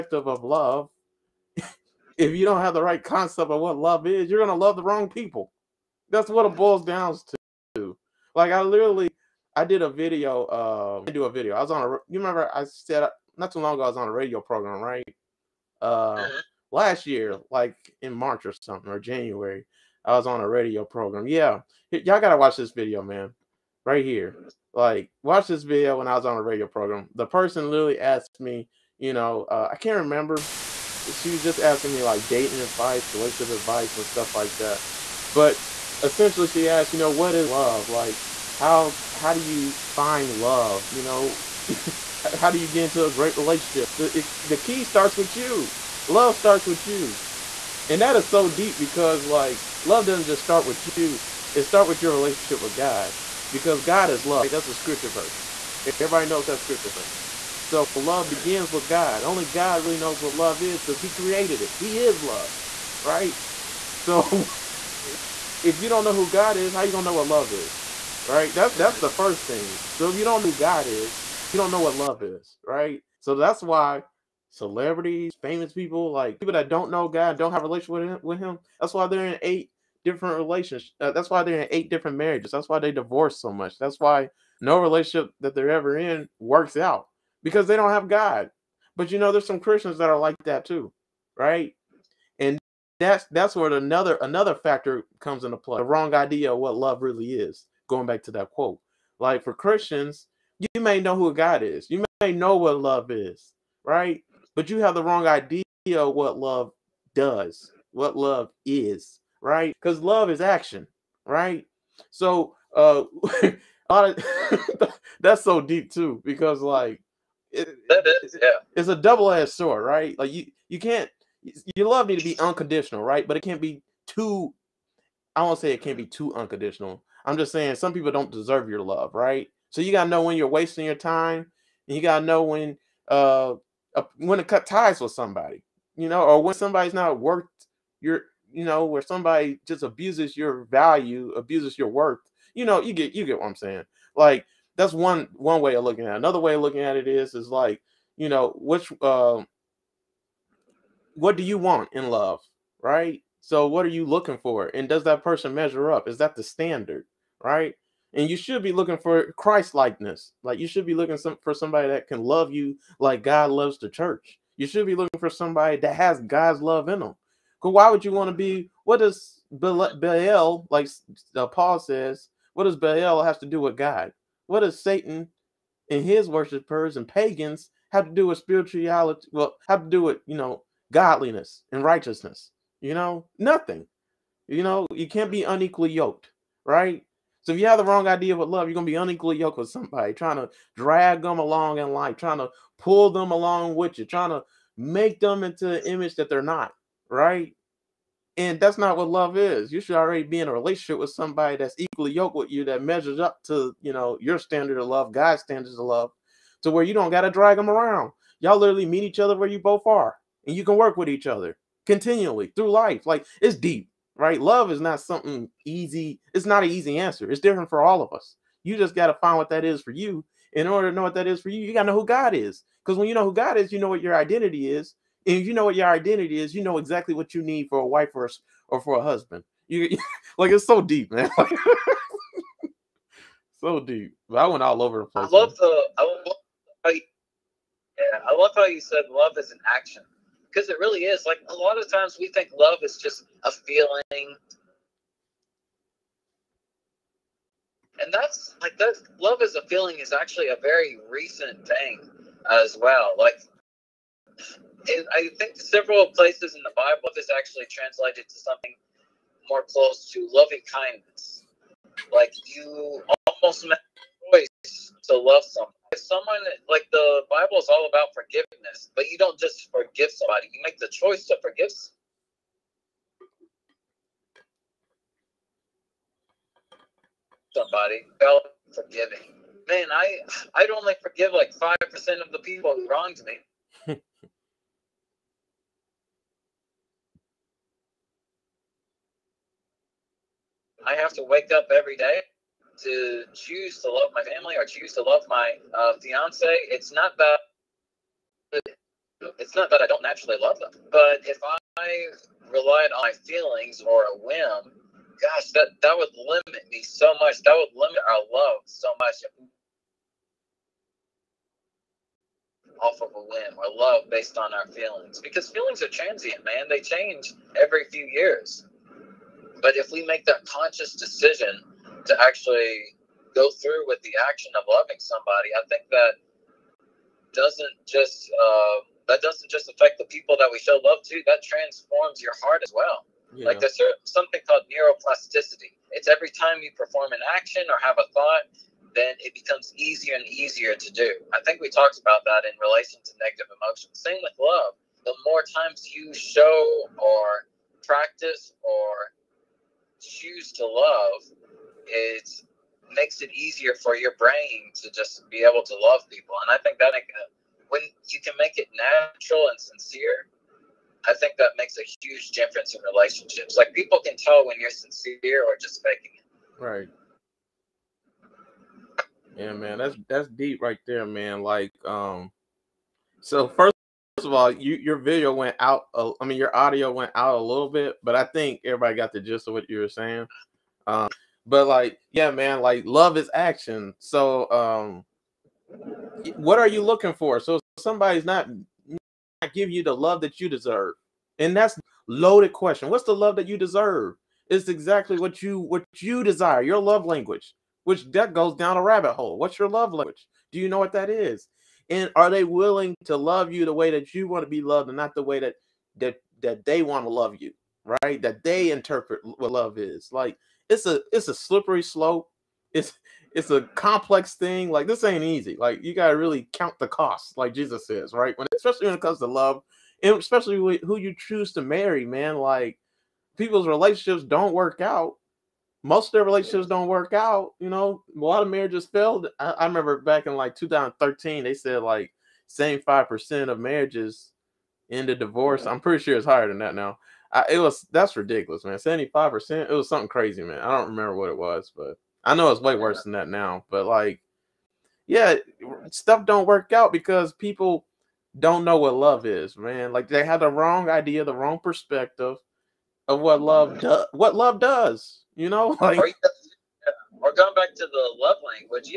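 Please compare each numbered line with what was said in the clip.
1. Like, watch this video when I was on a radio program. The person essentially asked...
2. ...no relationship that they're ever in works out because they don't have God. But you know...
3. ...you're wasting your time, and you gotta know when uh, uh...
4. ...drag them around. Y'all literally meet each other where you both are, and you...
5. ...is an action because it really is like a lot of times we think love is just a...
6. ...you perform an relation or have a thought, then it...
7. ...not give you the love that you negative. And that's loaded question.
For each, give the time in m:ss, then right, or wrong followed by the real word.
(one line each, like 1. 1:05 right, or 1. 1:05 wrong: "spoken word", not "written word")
1. 0:24 wrong: "literally", not "essentially"
2. 1:24 right
3. 2:10 right
4. 3:27 right
5. 3:59 right
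6. 5:36 wrong: "action", not "relation"
7. 6:29 wrong: "deserve", not "negative".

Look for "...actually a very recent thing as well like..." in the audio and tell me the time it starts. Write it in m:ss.
4:10.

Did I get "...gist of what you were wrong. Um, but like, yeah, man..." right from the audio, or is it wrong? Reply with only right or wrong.
wrong.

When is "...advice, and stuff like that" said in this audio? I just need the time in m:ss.
0:33.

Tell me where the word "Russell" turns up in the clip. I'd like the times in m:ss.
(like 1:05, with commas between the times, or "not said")
not said.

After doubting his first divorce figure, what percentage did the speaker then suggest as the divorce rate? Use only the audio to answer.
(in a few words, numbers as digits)
75%.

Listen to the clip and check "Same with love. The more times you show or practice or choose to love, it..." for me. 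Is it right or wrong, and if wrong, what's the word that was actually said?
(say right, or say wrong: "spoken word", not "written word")
right.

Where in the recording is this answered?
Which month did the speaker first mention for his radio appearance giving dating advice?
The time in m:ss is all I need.
0:18.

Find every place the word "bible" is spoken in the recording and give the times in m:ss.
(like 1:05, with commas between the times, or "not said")
4:16, 4:27.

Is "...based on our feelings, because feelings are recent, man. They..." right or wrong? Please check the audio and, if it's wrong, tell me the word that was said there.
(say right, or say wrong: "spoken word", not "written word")
wrong: "transient", not "recent".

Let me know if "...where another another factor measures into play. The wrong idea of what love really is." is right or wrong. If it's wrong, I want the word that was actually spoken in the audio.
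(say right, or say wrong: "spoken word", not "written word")
wrong: "comes", not "measures".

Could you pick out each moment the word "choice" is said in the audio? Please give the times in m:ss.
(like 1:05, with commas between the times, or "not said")
4:24, 4:30.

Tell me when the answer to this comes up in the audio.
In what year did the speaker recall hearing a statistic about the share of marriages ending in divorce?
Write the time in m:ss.
7:10.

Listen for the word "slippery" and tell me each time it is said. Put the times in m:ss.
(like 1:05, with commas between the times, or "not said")
6:51.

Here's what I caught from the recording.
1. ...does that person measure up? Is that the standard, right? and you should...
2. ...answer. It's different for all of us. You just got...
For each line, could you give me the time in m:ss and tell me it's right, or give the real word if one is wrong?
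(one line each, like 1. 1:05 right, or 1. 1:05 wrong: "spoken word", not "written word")
1. 2:34 right
2. 3:36 right.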